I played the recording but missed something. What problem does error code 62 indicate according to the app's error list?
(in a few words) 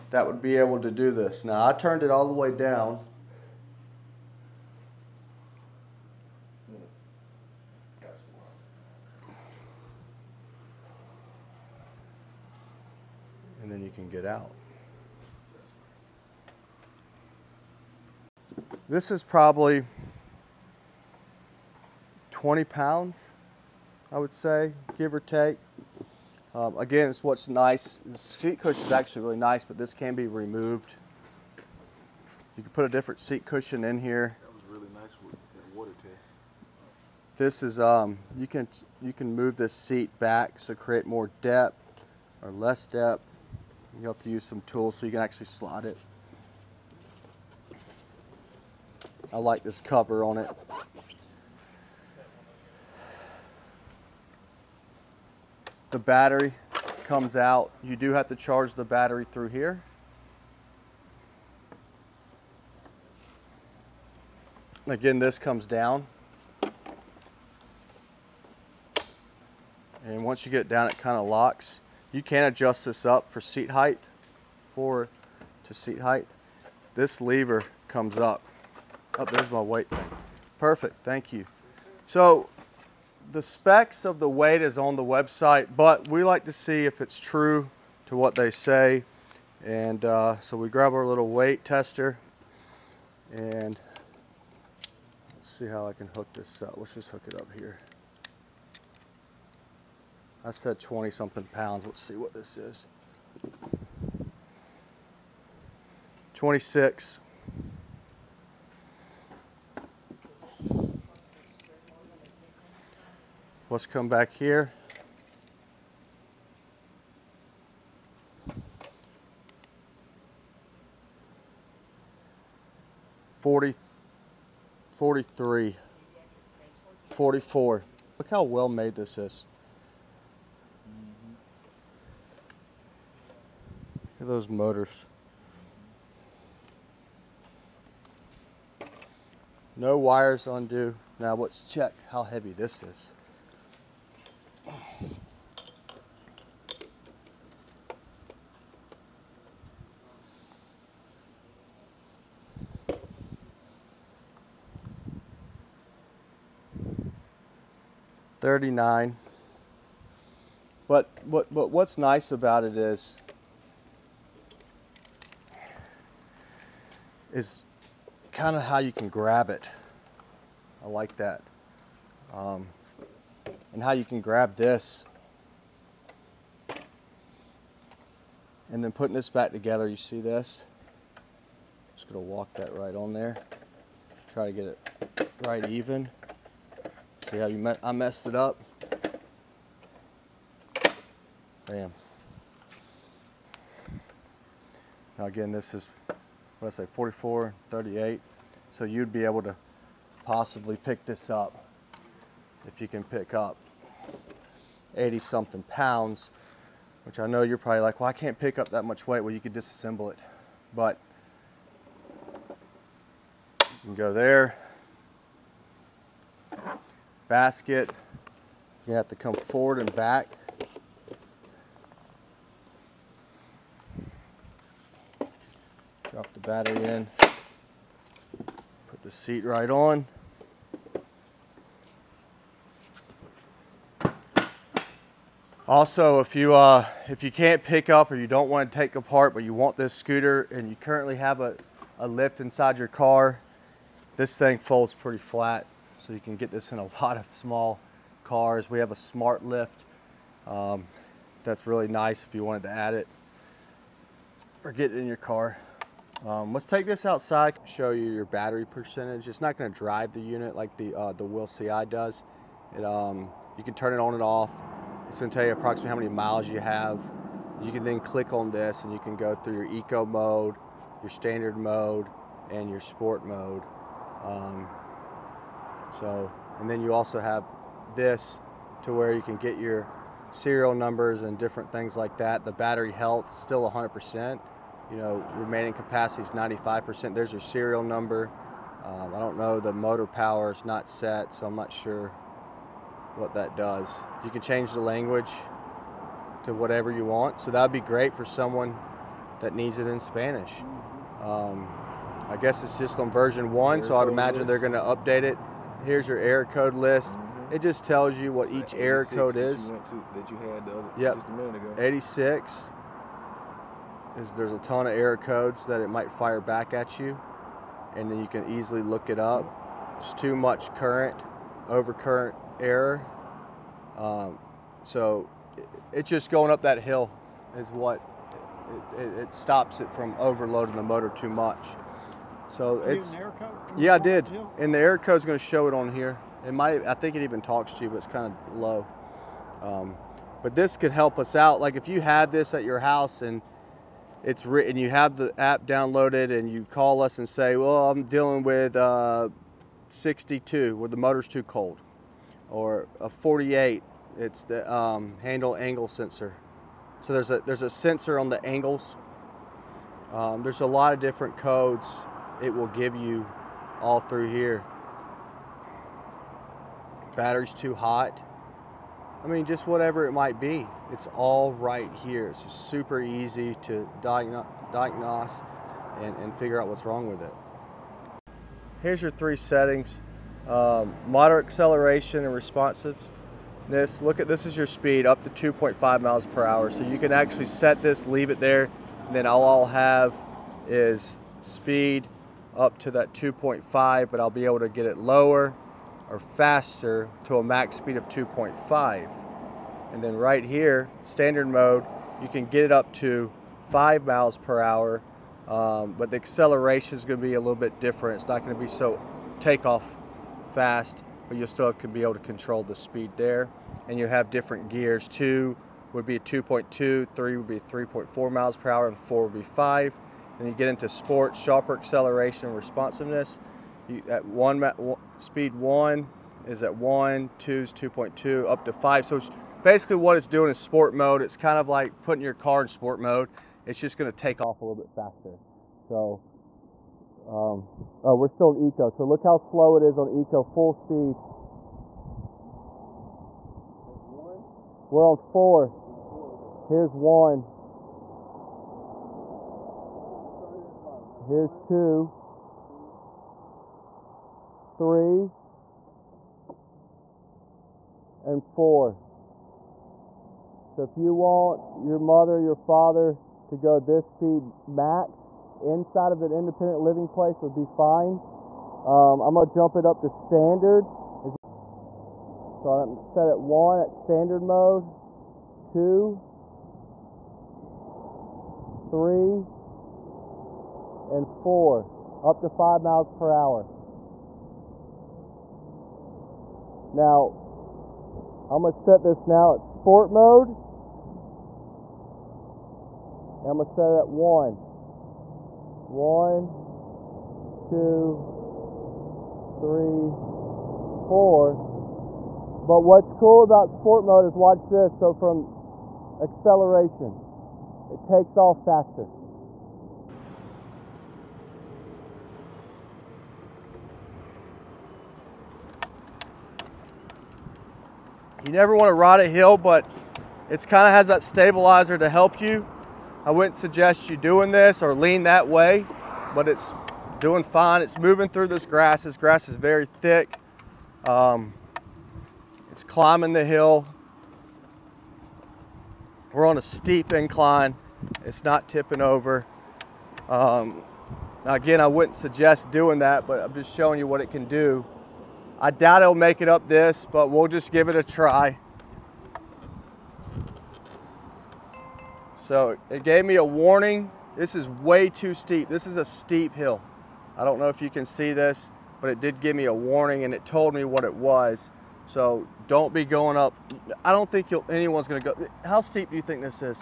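motor too cold.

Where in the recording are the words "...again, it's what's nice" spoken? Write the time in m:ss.
0:26.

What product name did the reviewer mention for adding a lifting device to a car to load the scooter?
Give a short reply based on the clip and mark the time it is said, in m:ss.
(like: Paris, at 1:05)
smart lift, at 4:08.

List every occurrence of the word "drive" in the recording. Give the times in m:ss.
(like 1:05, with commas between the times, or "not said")
4:19.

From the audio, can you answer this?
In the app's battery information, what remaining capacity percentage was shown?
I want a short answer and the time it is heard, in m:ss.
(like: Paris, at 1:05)
95%, at 4:46.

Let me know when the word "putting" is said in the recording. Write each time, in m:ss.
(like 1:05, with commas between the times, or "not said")
2:58, 7:12.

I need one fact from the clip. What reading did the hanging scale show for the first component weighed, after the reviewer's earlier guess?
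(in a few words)
26.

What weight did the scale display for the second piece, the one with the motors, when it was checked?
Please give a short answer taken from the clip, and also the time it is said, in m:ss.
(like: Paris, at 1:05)
39, at 2:38.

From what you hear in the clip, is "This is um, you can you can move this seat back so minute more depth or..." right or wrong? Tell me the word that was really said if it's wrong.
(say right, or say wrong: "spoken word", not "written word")
wrong: "create", not "minute".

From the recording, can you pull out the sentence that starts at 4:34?
Um, so, and then you also have this to where you can get your serial numbers and different things like that.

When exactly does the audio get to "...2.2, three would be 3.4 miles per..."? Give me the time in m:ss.
6:56.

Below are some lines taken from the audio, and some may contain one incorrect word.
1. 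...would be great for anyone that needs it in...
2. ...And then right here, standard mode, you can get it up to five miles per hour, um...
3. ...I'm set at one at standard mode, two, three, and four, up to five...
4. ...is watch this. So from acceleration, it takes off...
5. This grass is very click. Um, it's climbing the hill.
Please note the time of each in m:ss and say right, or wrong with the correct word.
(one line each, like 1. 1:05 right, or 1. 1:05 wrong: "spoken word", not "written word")
1. 4:57 wrong: "someone", not "anyone"
2. 6:39 right
3. 7:52 right
4. 8:24 right
5. 8:49 wrong: "thick", not "click".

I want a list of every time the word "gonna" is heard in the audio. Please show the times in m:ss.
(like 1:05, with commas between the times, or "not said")
3:02, 4:19, 4:25, 7:13, 7:49, 8:08, 8:13, 9:25.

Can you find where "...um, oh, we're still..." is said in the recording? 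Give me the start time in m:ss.
7:17.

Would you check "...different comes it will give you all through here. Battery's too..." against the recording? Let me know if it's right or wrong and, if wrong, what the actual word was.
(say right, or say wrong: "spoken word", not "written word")
wrong: "codes", not "comes".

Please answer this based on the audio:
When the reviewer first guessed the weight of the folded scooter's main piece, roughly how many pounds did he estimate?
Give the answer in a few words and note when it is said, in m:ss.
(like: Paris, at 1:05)
20 pounds, at 0:22.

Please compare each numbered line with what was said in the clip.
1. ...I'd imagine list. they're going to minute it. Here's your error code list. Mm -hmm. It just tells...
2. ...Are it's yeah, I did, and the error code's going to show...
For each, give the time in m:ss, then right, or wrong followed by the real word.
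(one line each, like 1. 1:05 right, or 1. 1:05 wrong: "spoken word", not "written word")
1. 5:03 wrong: "update", not "minute"
2. 5:32 right.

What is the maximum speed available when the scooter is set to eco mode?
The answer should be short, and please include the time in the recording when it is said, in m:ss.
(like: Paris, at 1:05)
2.5 mph, at 6:25.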